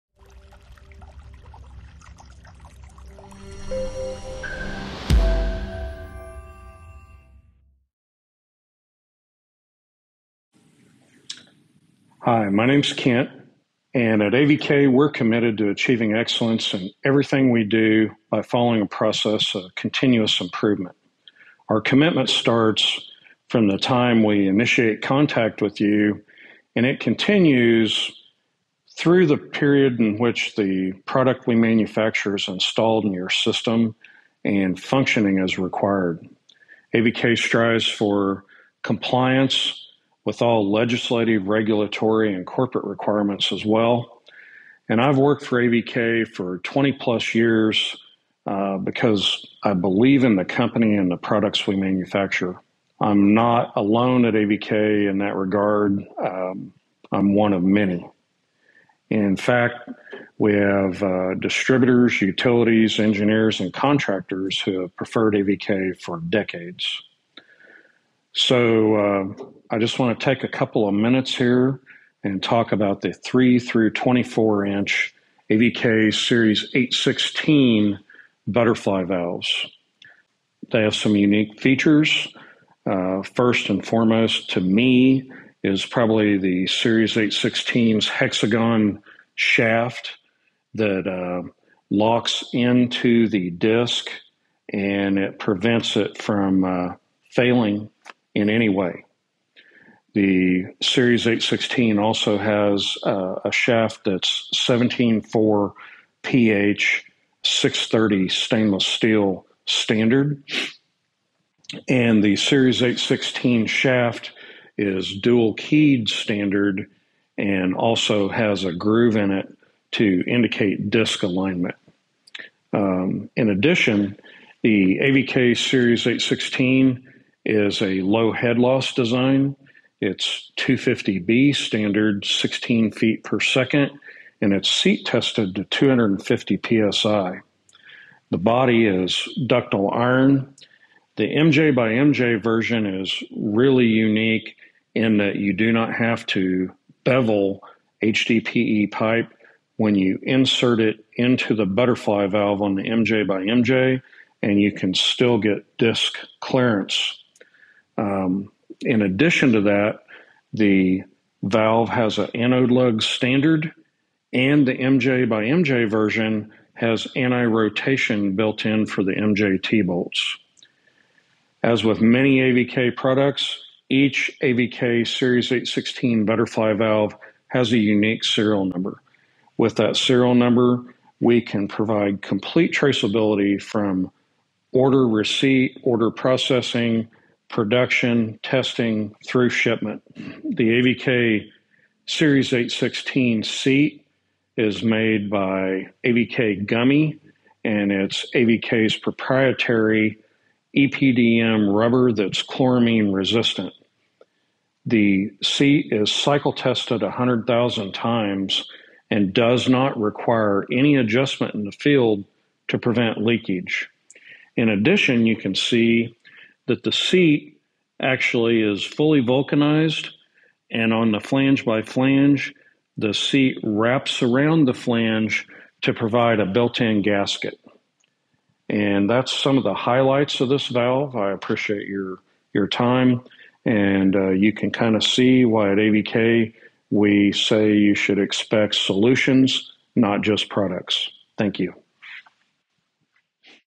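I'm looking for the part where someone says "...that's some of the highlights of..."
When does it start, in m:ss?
3:49.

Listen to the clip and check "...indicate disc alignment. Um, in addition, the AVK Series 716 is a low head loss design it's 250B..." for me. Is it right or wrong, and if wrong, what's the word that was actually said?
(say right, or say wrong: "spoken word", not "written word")
wrong: "816", not "716".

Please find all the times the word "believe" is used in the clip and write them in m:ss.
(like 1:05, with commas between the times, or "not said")
0:49.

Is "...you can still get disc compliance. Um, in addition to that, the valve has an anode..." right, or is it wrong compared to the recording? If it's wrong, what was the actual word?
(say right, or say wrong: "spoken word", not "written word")
wrong: "clearance", not "compliance".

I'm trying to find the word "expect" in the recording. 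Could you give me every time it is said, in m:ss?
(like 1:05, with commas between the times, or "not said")
3:58.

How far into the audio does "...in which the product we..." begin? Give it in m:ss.
0:29.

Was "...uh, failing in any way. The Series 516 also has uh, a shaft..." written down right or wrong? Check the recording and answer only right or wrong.
wrong.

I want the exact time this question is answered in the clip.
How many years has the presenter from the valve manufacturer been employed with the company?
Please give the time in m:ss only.
0:46.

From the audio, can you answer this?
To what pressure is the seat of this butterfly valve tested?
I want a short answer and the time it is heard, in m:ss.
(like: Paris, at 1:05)
250 psi, at 2:15.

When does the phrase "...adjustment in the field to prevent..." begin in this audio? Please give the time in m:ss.
3:30.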